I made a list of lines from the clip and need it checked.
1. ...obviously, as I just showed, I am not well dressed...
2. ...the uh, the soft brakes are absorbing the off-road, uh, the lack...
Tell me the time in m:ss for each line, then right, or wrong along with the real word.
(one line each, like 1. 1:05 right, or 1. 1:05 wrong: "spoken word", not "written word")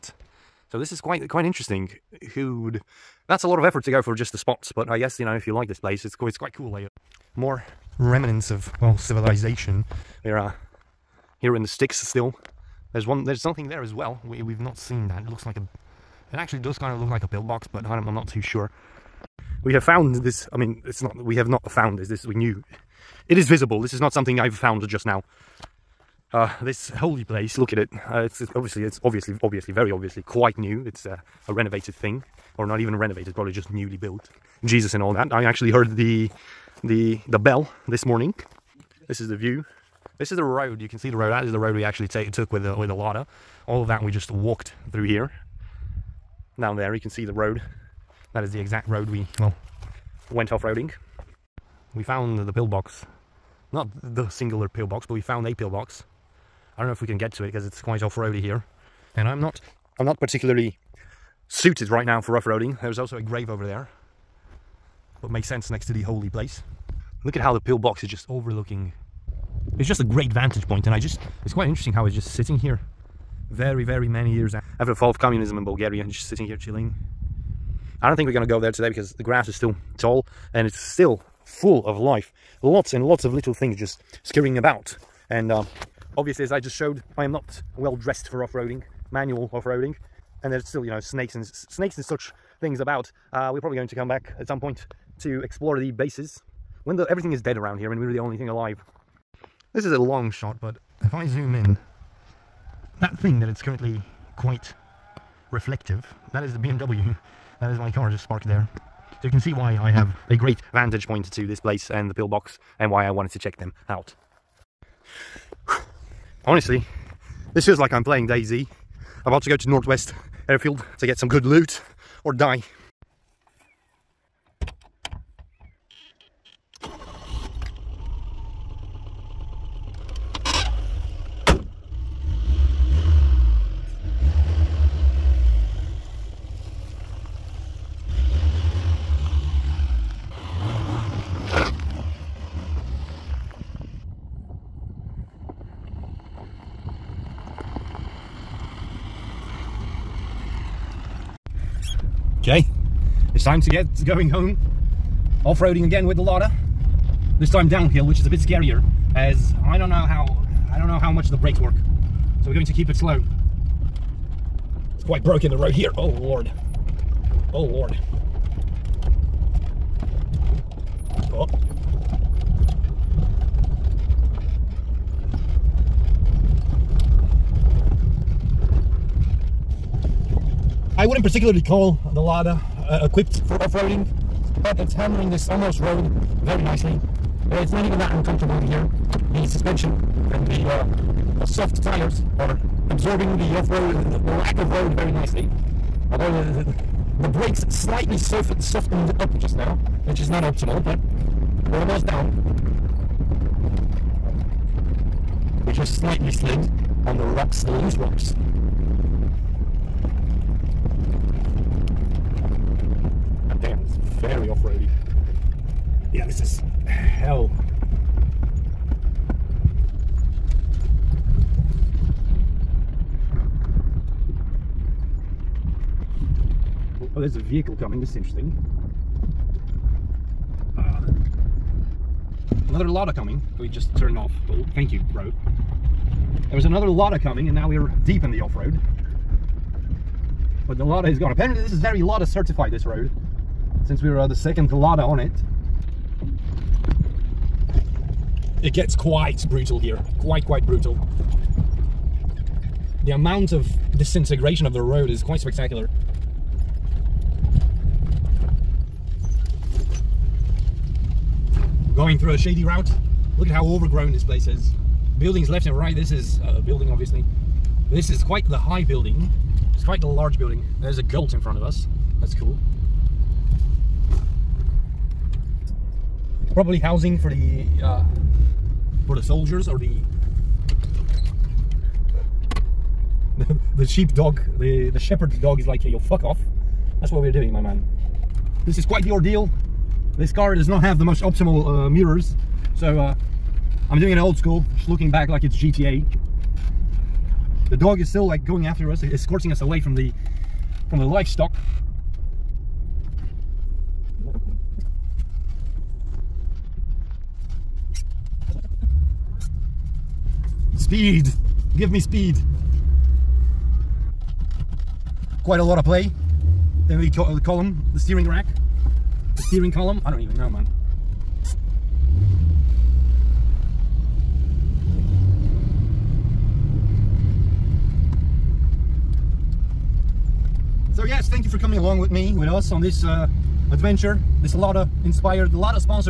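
1. 1:26 right
2. 3:10 wrong: "tires", not "brakes".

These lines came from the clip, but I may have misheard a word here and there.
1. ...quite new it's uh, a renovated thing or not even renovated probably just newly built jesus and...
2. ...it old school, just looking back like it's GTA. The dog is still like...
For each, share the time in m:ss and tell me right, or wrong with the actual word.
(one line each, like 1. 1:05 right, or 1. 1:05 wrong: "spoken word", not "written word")
1. 0:30 right
2. 4:54 right.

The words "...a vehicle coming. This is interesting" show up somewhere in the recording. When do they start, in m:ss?
3:47.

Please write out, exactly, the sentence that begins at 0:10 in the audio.
There are uh, here in the sticks still.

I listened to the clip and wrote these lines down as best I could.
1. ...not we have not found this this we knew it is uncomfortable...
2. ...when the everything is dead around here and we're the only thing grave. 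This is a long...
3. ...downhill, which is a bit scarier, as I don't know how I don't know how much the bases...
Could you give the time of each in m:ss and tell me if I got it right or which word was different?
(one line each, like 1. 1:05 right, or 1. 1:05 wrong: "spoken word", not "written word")
1. 0:21 wrong: "visible", not "uncomfortable"
2. 1:36 wrong: "alive", not "grave"
3. 2:37 wrong: "brakes", not "bases".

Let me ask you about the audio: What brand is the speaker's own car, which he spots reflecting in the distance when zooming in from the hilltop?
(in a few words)
BMW.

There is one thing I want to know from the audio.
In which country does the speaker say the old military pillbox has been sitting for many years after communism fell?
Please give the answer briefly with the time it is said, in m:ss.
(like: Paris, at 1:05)
Bulgaria, at 1:15.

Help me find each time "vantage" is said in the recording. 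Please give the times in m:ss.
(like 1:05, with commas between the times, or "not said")
1:10, 1:50.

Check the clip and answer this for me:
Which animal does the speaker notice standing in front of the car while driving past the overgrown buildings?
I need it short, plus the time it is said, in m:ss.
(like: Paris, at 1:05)
Goat, at 4:31.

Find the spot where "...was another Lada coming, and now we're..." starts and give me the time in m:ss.
3:56.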